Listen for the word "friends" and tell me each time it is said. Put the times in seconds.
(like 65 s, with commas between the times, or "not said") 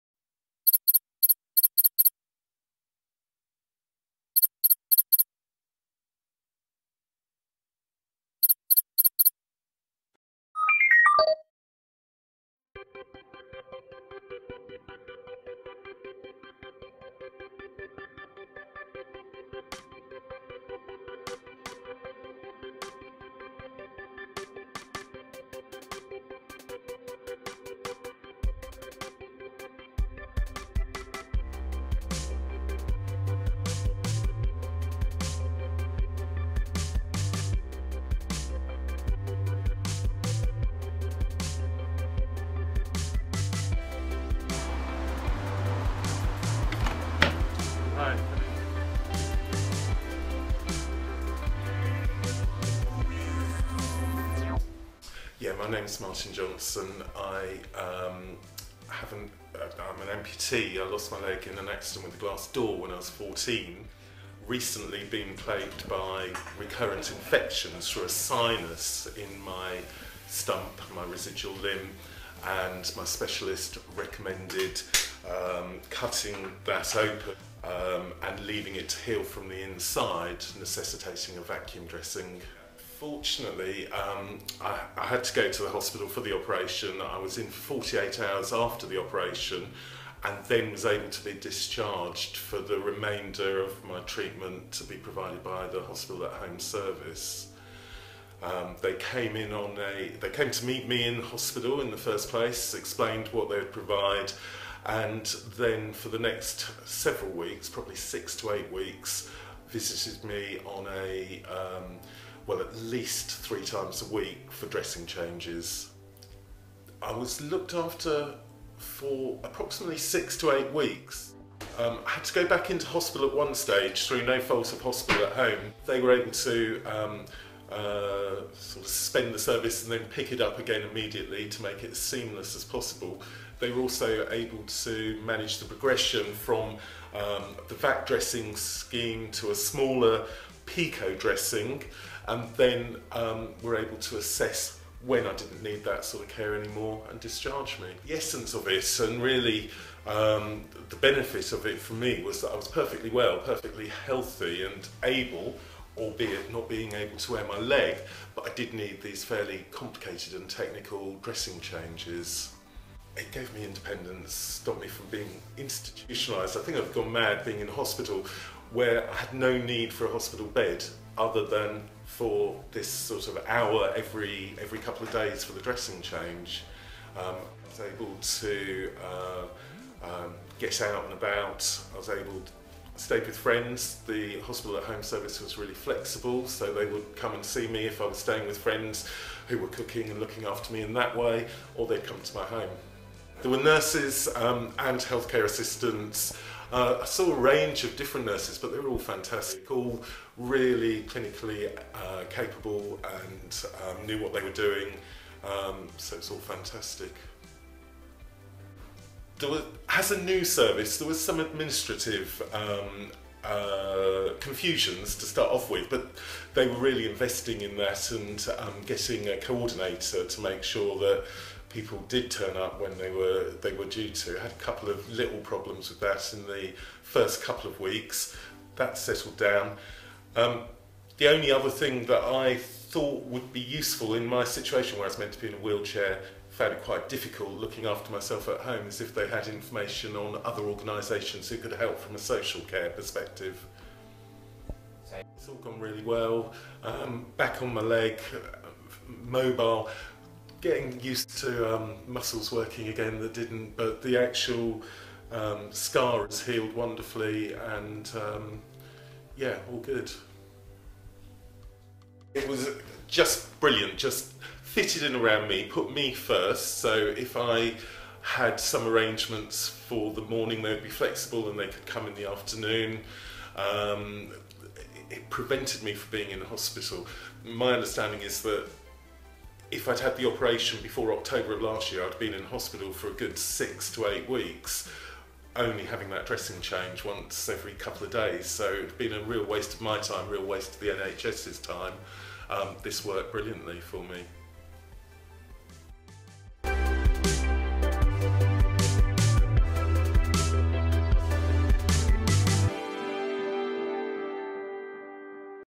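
183 s, 188 s.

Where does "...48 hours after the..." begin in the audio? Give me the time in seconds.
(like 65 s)
87 s.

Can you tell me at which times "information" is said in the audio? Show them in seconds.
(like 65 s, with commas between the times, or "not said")
239 s.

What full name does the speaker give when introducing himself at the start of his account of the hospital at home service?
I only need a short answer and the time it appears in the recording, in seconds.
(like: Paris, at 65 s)
Martin Johnson, at 56 s.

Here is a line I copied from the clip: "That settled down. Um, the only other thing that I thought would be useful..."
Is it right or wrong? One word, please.
right.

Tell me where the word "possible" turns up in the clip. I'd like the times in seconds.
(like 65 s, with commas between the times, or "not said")
132 s.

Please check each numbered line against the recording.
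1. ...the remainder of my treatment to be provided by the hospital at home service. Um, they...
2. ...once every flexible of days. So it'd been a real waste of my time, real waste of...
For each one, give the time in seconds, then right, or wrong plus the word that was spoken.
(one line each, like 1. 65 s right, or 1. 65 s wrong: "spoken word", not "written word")
1. 92 s right
2. 287 s wrong: "couple", not "flexible".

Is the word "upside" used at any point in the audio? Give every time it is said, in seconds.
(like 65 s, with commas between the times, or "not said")
not said.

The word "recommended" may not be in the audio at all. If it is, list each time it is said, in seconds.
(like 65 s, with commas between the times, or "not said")
73 s.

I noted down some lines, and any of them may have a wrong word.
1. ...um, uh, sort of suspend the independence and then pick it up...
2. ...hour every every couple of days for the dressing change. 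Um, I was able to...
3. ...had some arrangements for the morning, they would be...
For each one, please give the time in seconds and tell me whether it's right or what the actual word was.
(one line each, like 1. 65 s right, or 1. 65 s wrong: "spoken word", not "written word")
1. 126 s wrong: "service", not "independence"
2. 173 s right
3. 268 s right.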